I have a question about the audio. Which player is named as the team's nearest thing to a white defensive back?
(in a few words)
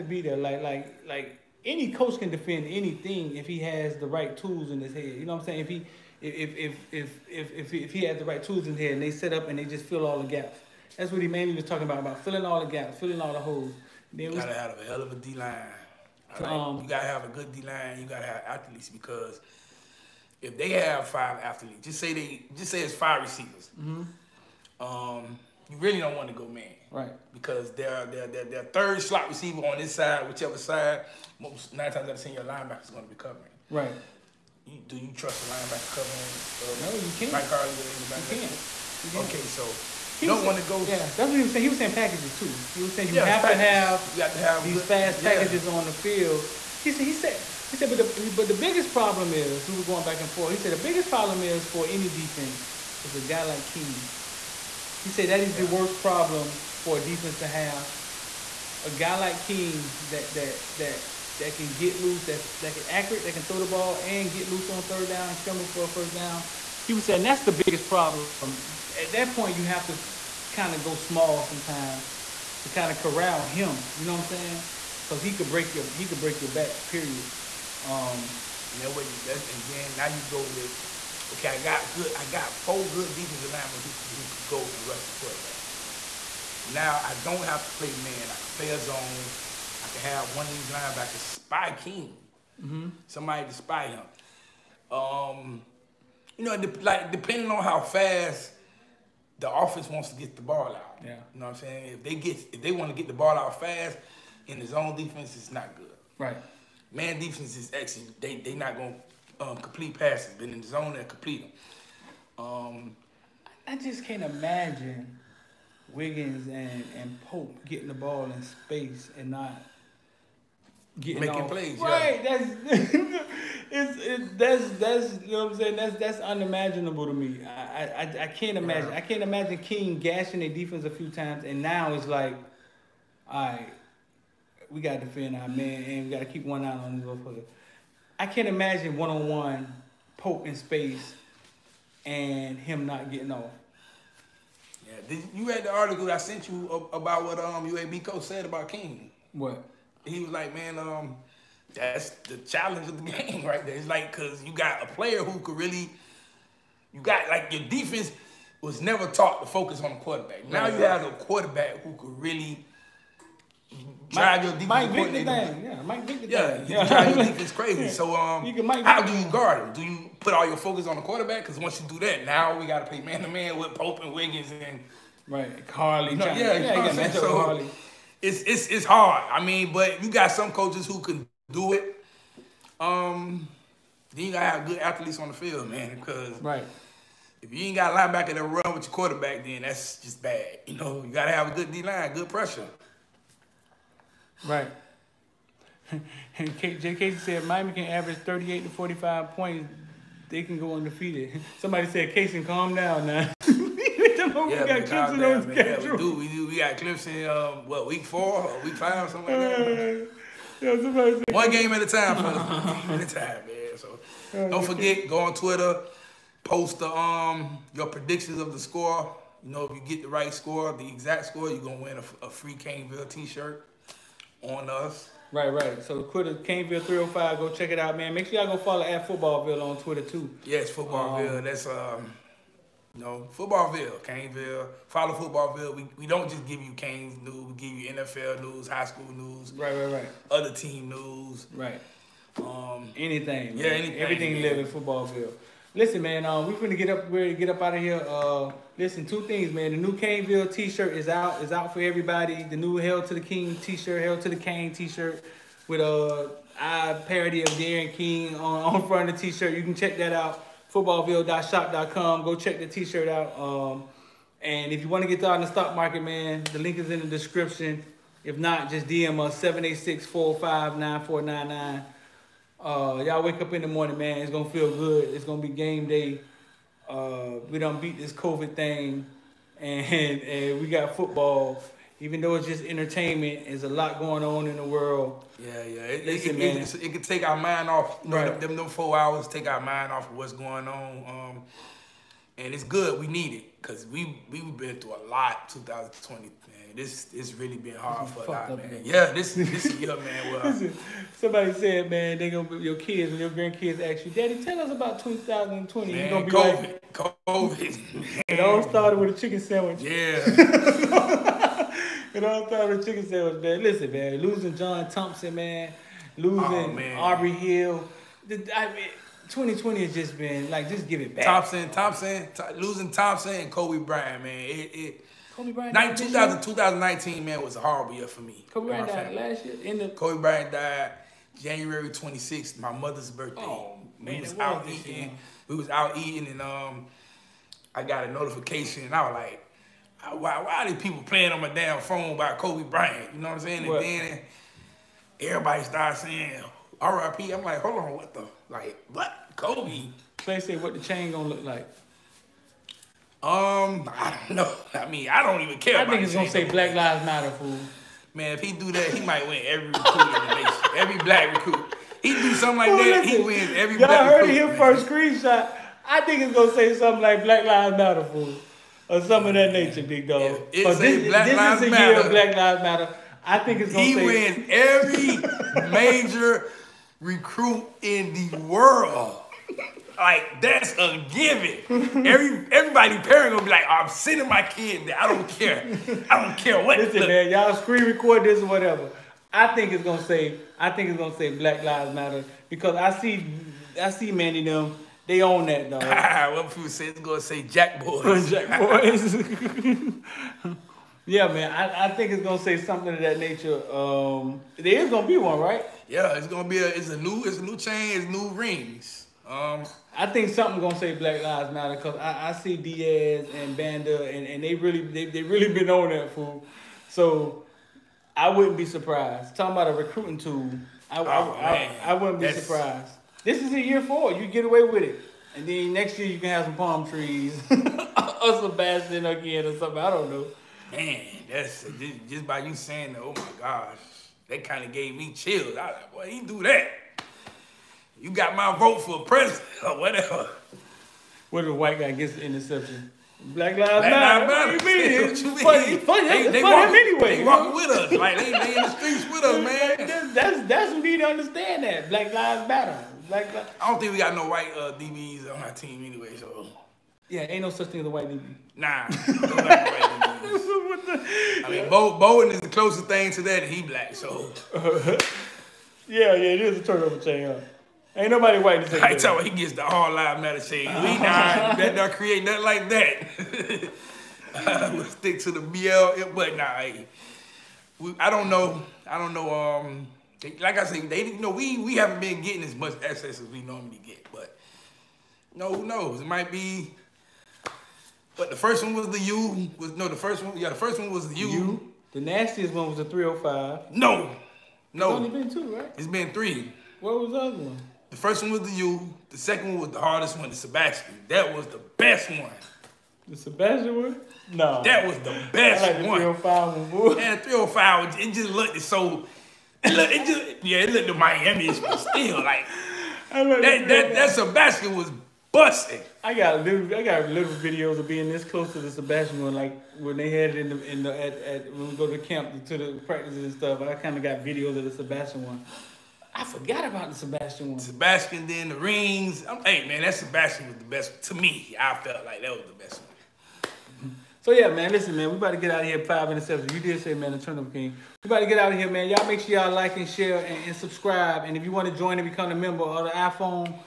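Bowen.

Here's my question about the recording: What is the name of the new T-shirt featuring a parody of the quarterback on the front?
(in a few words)
Hell to the King.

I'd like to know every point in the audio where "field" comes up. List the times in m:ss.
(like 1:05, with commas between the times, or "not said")
0:45, 3:05.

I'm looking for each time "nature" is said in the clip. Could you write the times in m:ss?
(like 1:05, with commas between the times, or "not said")
6:09, 6:43.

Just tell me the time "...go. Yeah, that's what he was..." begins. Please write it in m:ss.
0:40.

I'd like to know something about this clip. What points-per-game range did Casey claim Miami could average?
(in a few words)
38 to 45.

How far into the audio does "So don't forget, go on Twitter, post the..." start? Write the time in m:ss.
3:33.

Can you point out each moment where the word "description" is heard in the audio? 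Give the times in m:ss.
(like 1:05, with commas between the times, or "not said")
4:27.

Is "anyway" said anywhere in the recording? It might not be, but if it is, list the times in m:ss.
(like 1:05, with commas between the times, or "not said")
7:26, 7:35.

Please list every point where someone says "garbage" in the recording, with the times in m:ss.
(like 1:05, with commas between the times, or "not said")
not said.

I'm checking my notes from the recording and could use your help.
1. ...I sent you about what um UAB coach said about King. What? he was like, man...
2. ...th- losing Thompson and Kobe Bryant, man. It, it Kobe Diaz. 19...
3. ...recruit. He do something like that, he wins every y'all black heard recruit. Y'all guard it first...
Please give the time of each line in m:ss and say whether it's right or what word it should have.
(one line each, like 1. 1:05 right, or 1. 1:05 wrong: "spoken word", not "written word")
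1. 2:26 right
2. 5:22 wrong: "Bryant", not "Diaz"
3. 6:01 wrong: "heard", not "guard".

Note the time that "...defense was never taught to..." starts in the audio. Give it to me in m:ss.
2:37.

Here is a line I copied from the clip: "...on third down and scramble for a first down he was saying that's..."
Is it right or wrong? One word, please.
right.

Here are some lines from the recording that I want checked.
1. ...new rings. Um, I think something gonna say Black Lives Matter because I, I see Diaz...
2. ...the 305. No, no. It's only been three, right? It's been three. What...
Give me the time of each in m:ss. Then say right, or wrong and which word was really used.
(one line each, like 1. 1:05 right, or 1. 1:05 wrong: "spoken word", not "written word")
1. 6:48 right
2. 8:12 wrong: "two", not "three".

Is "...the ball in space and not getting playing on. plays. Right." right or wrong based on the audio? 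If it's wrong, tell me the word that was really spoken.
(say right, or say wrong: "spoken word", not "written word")
wrong: "making", not "playing".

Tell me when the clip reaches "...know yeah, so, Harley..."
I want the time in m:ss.
2:56.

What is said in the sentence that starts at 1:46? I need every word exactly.
Man defense is actually they they not gonna um, complete passes, but in the zone they complete them.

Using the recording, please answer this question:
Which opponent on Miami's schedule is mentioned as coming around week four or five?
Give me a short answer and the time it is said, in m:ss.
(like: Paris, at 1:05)
Clemson, at 3:26.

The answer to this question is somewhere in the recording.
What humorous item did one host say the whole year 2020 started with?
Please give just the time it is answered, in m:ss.
5:09.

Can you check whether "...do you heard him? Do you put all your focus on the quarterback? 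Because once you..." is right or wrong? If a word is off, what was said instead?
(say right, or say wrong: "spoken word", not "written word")
wrong: "guard", not "heard".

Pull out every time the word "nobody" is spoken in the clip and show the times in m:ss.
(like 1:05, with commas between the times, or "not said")
7:48.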